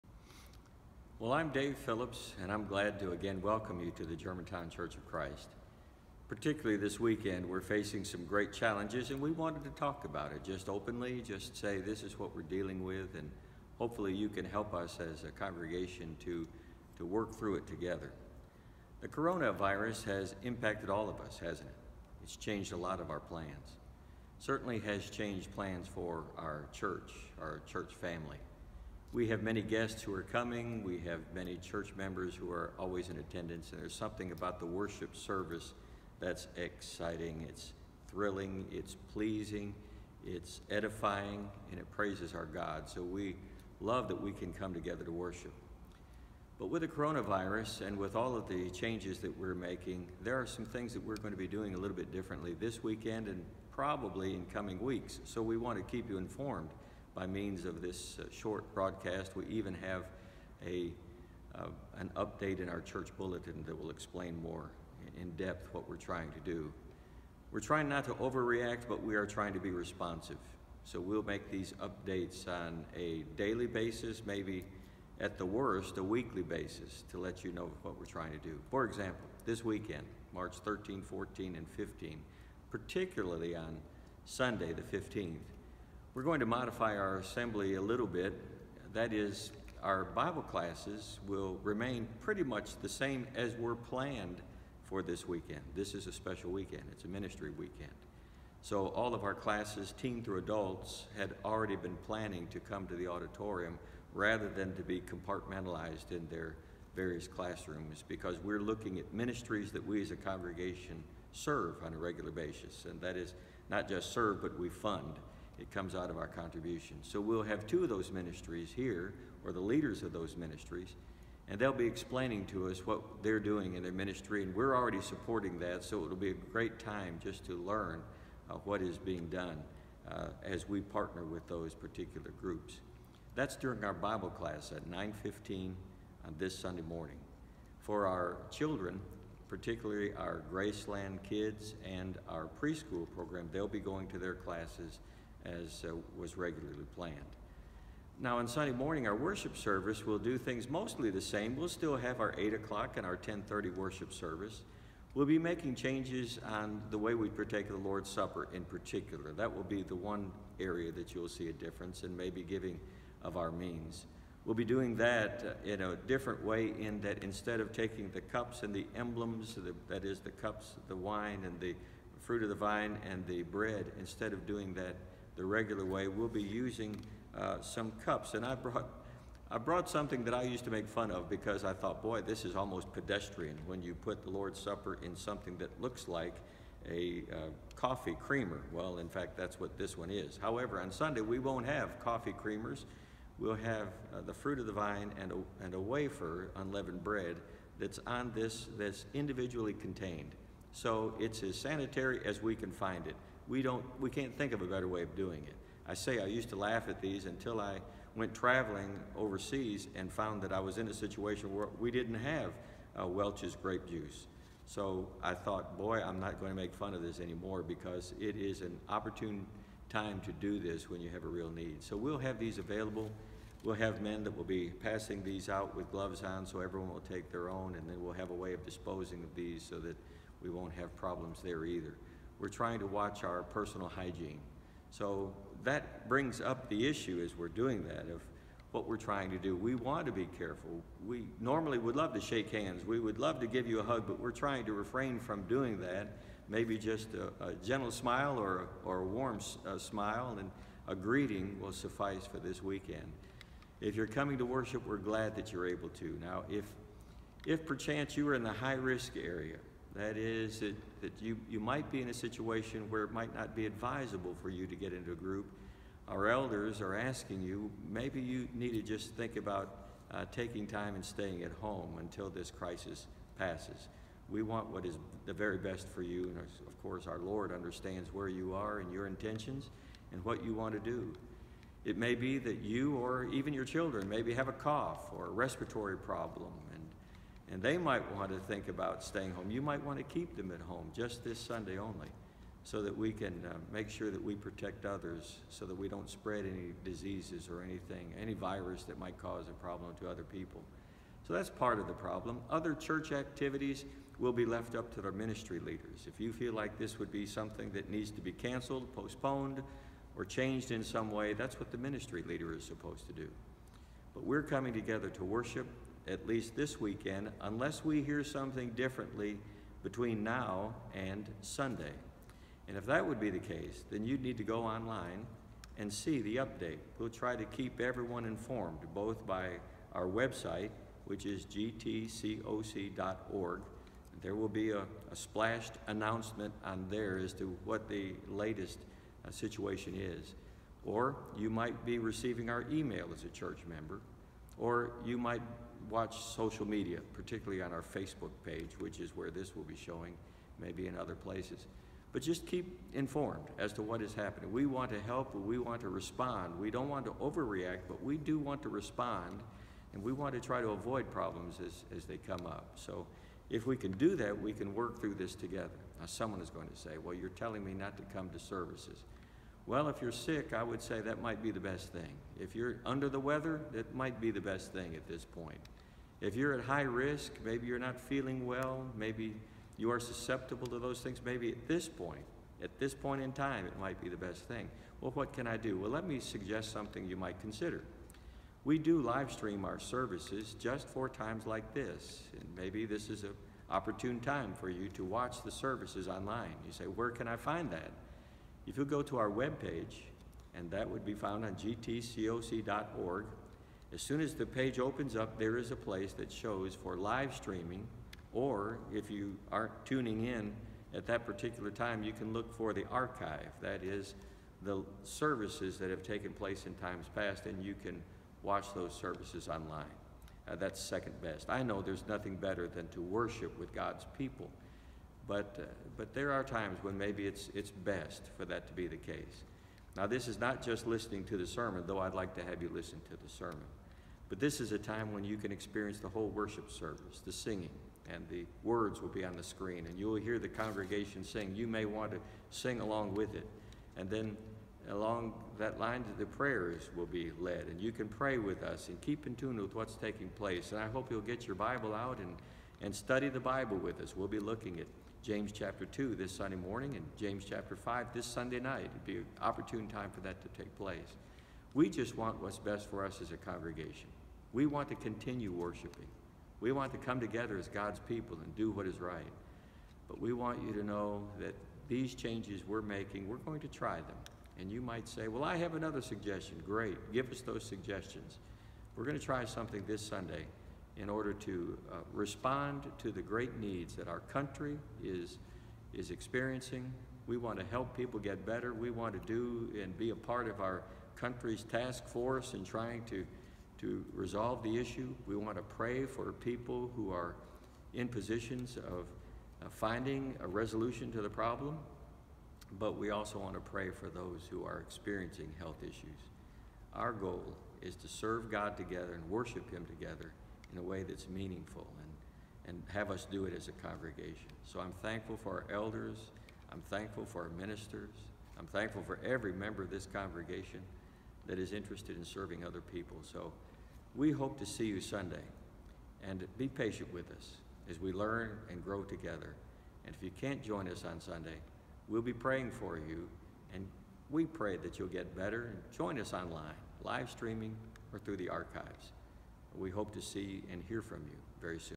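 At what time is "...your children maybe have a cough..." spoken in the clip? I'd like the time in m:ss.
4:43.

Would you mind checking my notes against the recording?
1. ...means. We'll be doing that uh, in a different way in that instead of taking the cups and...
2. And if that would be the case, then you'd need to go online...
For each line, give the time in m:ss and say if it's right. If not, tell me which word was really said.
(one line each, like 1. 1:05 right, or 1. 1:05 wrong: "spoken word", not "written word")
1. 2:43 right
2. 5:22 right.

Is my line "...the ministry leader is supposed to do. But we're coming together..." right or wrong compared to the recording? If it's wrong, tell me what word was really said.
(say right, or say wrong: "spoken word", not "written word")
right.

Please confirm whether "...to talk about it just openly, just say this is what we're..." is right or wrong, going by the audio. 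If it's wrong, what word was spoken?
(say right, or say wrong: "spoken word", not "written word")
right.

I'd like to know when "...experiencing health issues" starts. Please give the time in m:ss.
8:24.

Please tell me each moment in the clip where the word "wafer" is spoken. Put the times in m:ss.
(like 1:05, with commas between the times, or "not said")
3:15.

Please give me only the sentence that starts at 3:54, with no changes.
So that brings up the issue as we're doing that of what we're trying to do.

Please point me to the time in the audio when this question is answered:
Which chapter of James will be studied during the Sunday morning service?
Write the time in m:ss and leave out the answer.
7:35.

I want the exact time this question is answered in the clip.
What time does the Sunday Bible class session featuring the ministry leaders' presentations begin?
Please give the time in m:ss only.
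2:14.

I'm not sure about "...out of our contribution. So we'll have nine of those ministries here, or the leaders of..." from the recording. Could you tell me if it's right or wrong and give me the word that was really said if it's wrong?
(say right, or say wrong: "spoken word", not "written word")
wrong: "two", not "nine".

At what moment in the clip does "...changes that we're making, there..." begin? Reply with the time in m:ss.
0:48.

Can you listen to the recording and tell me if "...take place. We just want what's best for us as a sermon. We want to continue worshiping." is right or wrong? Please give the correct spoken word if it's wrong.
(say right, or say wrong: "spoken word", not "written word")
wrong: "congregation", not "sermon".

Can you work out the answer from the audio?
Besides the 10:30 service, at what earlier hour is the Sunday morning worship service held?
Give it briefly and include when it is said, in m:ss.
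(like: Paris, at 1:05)
8 o'clock, at 2:32.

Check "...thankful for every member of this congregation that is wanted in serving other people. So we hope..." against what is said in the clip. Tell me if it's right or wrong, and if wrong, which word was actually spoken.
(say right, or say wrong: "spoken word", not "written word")
wrong: "interested", not "wanted".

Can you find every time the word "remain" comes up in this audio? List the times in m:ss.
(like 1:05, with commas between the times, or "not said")
1:31.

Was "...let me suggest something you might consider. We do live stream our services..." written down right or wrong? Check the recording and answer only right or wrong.
right.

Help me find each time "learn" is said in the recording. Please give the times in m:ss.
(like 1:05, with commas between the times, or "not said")
2:07, 8:48.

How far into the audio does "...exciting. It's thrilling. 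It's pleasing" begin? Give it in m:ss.
0:36.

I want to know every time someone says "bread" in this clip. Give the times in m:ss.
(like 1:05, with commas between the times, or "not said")
2:53, 3:17.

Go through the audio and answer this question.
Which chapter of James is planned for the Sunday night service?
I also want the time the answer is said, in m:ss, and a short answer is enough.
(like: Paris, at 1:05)
chapter 5, at 7:37.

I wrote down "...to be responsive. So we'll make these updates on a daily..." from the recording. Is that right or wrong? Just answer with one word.
right.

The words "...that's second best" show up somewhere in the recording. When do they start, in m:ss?
7:00.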